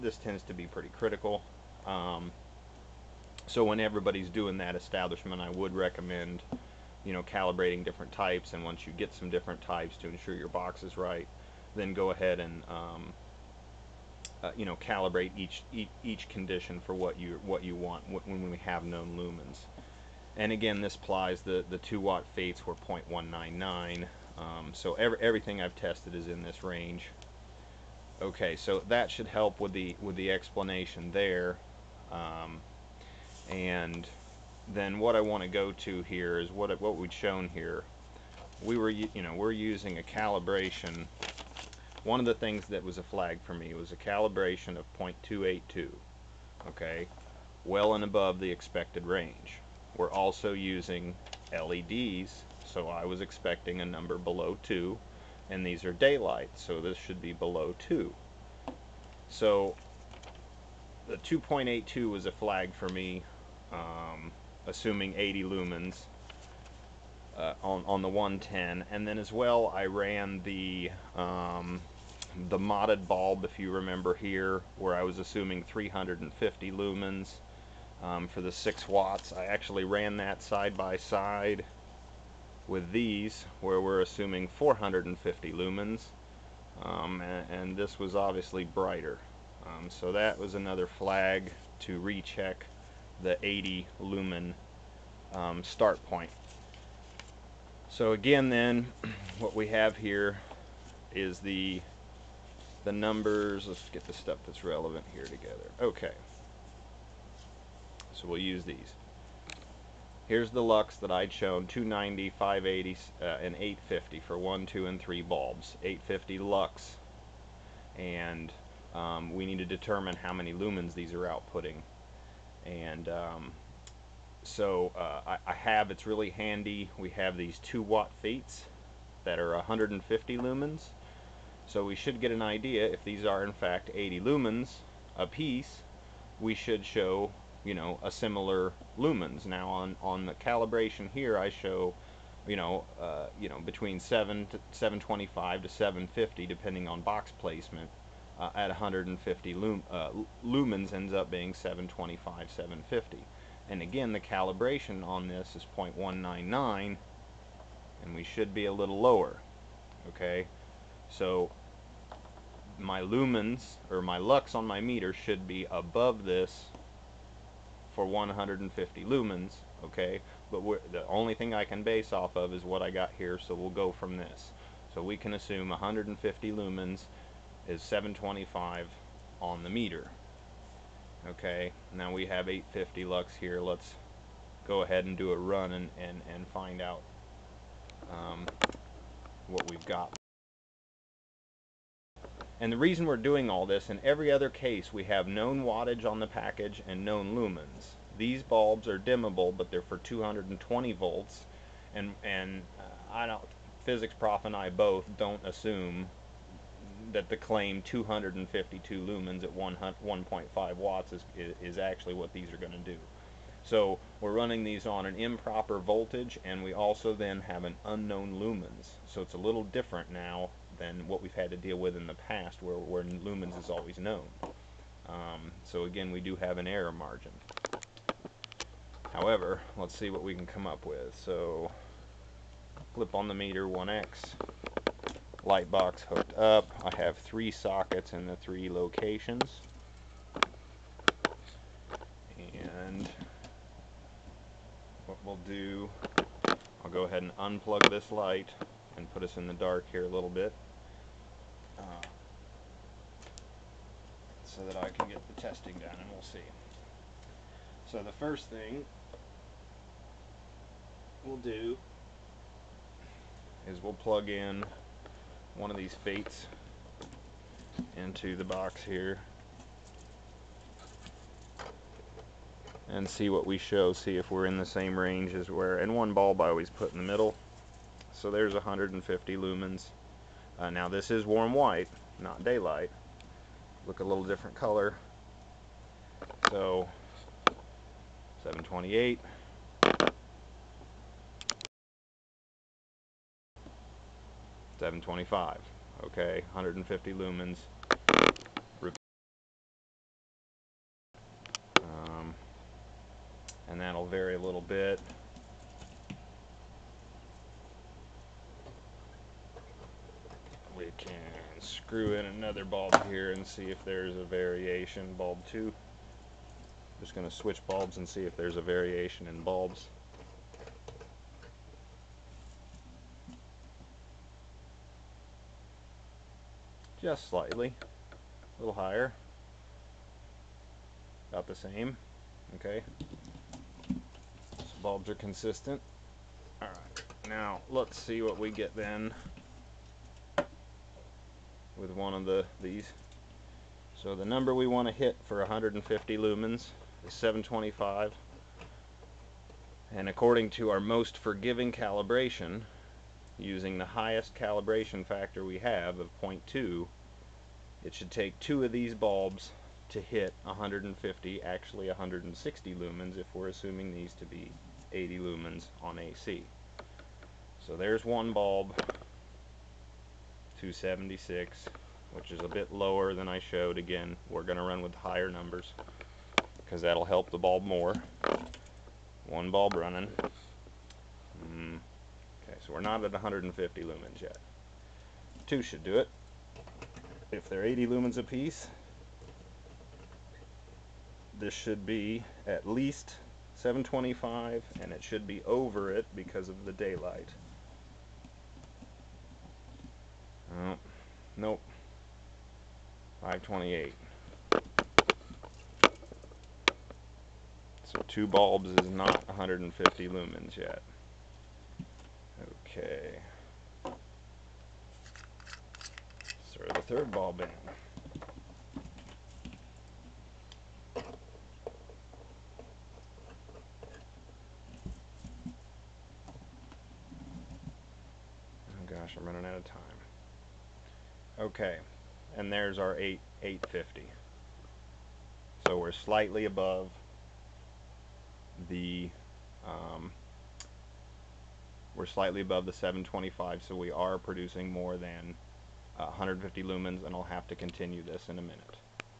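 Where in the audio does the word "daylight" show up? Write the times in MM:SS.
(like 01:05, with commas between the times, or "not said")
00:55, 04:42, 06:36.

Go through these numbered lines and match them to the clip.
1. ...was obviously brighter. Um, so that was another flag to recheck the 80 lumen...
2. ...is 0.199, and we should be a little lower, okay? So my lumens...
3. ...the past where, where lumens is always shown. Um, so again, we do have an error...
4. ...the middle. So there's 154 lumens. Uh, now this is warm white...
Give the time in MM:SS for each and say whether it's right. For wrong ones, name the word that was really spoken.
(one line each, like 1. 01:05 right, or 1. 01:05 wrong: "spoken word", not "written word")
1. 01:27 right
2. 02:35 right
3. 03:42 wrong: "known", not "shown"
4. 04:36 wrong: "150", not "154".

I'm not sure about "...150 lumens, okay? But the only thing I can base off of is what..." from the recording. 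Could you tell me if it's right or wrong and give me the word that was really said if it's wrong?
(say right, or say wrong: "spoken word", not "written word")
right.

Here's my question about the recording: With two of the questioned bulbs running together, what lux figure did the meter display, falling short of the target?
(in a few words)
528.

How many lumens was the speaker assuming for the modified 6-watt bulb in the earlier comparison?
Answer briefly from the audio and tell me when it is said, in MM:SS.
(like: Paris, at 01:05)
350, at 01:15.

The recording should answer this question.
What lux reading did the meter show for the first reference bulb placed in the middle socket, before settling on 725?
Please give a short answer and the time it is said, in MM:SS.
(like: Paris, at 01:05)
728, at 04:48.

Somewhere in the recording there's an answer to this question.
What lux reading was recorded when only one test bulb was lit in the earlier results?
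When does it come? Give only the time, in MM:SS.
01:51.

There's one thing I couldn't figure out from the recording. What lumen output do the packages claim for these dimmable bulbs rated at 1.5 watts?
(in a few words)
252.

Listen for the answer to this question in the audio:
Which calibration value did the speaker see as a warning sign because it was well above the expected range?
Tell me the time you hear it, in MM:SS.
00:44.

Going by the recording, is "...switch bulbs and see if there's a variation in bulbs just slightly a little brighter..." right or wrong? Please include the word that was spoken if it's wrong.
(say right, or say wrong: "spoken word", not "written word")
wrong: "higher", not "brighter".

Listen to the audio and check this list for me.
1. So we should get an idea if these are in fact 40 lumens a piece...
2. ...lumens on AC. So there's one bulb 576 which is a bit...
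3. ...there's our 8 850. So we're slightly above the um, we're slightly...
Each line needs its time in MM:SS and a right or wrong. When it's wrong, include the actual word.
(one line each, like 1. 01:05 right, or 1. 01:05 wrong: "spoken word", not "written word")
1. 02:11 wrong: "80", not "40"
2. 06:05 wrong: "276", not "576"
3. 07:12 right.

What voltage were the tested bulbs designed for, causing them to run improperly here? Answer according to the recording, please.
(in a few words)
220 volts.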